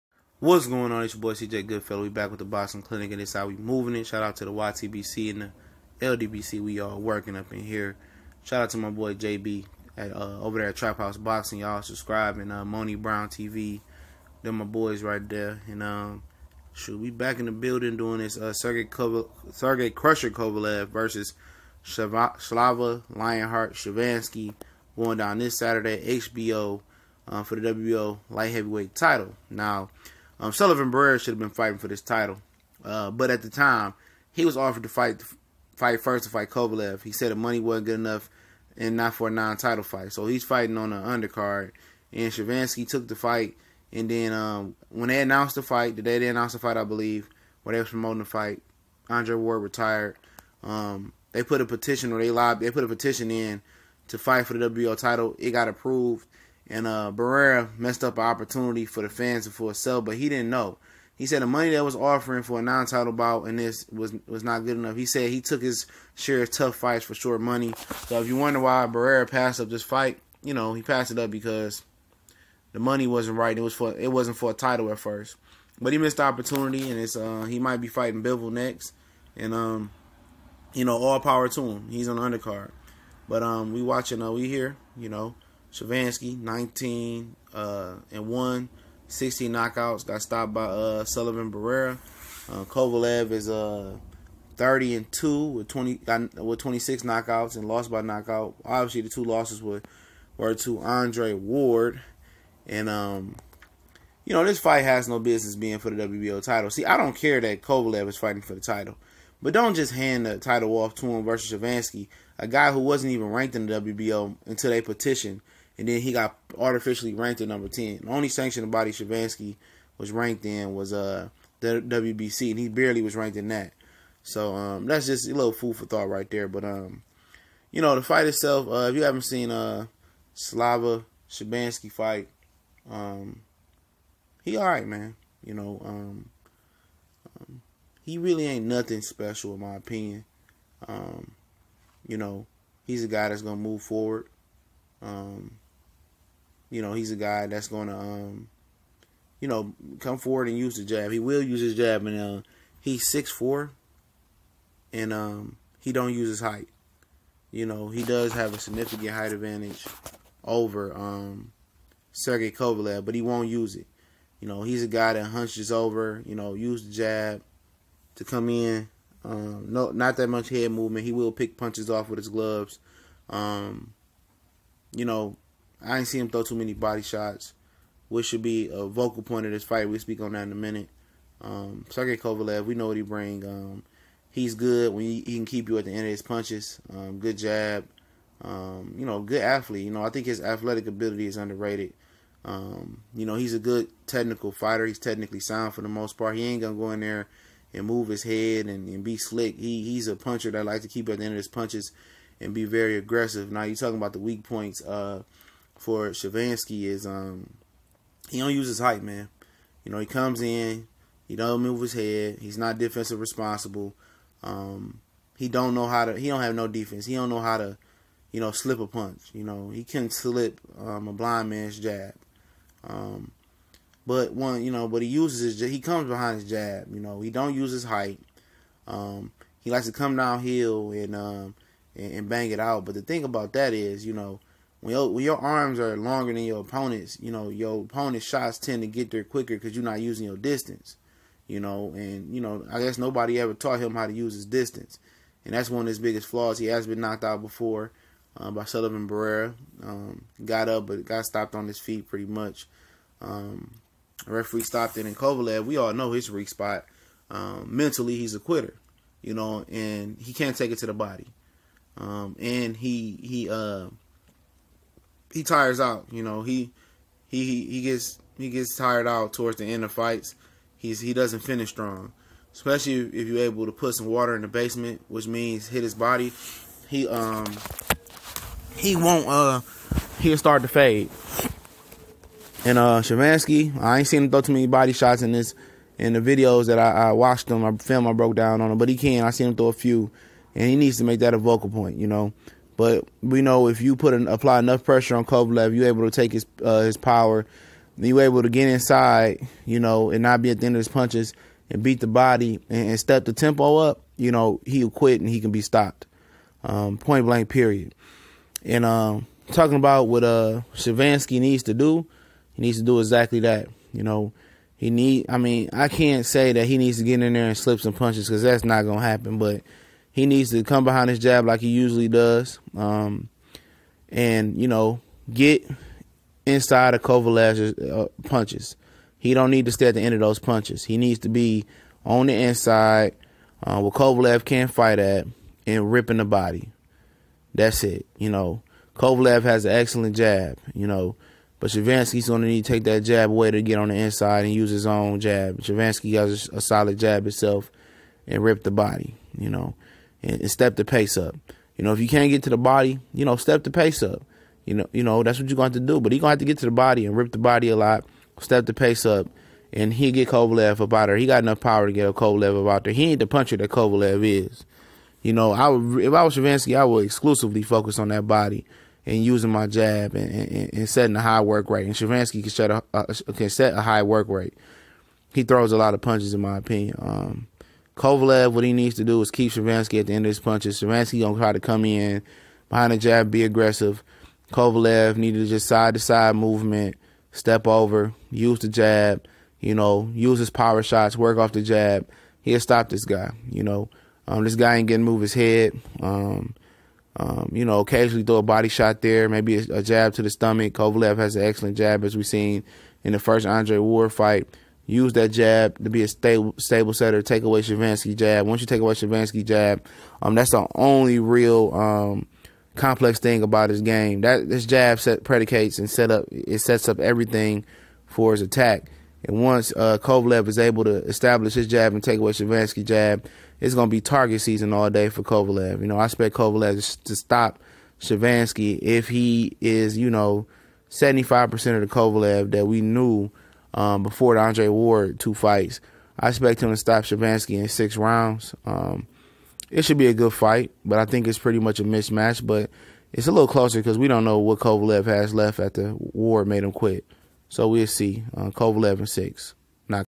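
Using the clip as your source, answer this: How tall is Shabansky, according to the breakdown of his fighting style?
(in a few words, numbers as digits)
6'4".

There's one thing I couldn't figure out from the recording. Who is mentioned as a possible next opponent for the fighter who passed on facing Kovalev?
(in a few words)
Bivol.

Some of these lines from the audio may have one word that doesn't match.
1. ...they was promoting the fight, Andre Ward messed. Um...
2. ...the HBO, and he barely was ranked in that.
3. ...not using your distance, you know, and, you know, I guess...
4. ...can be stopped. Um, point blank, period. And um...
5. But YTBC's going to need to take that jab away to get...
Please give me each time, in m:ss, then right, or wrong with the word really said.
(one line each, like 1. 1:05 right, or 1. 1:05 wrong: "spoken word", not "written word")
1. 0:47 wrong: "retired", not "messed"
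2. 2:01 wrong: "WBC", not "HBO"
3. 3:59 right
4. 5:05 right
5. 5:41 wrong: "Shavansky", not "YTBC".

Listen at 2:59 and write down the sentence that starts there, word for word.
We speak on that in a minute.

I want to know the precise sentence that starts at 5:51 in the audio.
You know, if you can't get to the body, you know, step the pace up.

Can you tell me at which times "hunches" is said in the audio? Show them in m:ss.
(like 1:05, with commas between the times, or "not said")
2:45.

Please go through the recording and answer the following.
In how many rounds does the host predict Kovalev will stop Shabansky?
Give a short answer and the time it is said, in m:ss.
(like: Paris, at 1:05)
6, at 7:17.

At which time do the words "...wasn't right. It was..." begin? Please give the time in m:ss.
1:13.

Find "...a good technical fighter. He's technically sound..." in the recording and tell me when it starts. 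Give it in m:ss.
3:13.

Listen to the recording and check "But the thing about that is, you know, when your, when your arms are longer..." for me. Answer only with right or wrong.
right.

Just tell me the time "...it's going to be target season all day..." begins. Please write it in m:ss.
7:03.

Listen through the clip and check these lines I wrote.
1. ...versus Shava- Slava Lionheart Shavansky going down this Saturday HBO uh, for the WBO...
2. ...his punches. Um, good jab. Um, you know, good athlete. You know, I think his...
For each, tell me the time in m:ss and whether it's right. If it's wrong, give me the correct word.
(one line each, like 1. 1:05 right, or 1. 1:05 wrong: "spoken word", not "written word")
1. 0:20 right
2. 3:06 right.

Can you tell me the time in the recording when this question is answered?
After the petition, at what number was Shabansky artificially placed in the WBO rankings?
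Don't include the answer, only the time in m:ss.
1:57.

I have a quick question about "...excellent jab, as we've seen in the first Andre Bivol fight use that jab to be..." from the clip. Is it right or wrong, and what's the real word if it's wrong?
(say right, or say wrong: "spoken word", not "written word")
wrong: "Ward", not "Bivol".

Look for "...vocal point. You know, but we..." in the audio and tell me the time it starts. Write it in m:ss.
4:51.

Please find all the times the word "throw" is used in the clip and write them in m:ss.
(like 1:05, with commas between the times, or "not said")
2:56, 4:44, 4:49, 6:15, 6:38.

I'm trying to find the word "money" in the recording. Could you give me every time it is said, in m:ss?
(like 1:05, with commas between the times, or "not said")
0:37, 1:01, 1:07, 1:12.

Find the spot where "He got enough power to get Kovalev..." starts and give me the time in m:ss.
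6:01.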